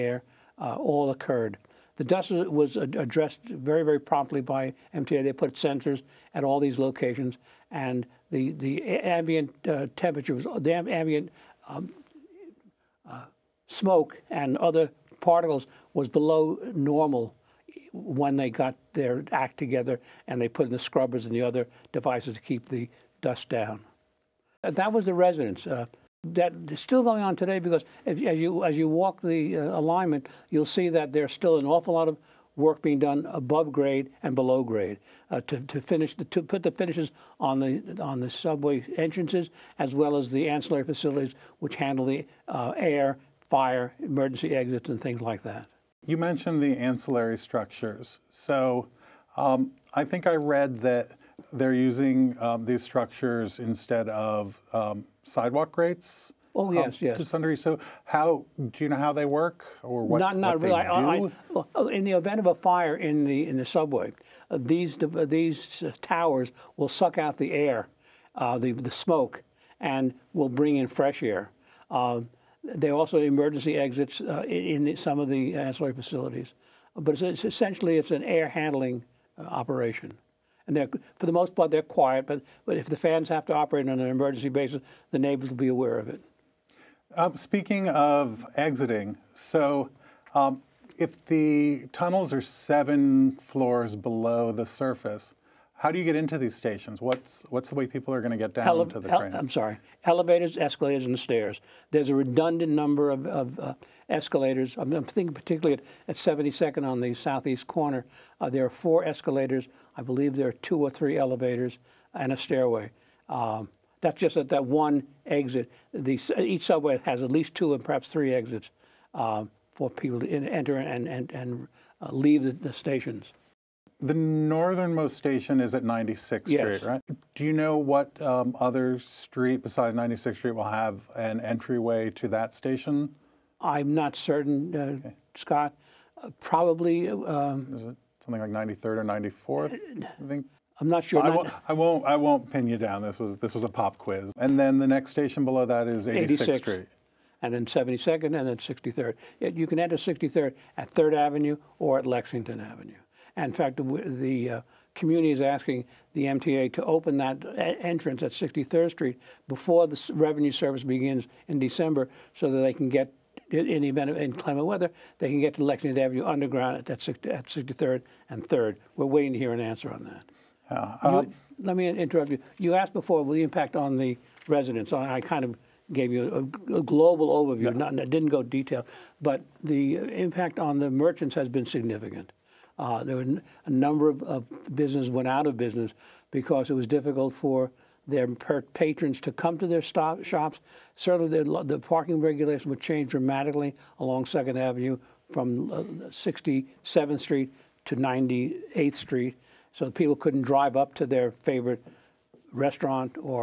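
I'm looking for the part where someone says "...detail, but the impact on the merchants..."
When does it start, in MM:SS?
02:58.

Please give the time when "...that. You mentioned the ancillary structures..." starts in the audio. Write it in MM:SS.
00:45.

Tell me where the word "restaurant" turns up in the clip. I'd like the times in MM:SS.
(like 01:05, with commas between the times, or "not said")
03:22.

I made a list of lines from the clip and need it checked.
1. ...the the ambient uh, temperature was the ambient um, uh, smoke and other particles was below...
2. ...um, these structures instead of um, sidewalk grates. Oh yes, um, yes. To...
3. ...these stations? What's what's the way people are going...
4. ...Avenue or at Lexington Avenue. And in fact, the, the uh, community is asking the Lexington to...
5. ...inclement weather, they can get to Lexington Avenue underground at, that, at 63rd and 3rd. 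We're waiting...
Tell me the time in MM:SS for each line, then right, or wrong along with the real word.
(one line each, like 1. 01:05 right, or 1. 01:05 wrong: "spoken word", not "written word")
1. 00:08 right
2. 00:52 right
3. 01:36 right
4. 02:31 wrong: "MTA", not "Lexington"
5. 02:44 right.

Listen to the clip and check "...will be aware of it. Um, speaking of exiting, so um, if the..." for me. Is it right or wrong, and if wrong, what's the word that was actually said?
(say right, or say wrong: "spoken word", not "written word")
right.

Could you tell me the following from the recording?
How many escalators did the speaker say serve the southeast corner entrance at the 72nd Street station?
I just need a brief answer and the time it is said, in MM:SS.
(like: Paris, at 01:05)
4, at 01:48.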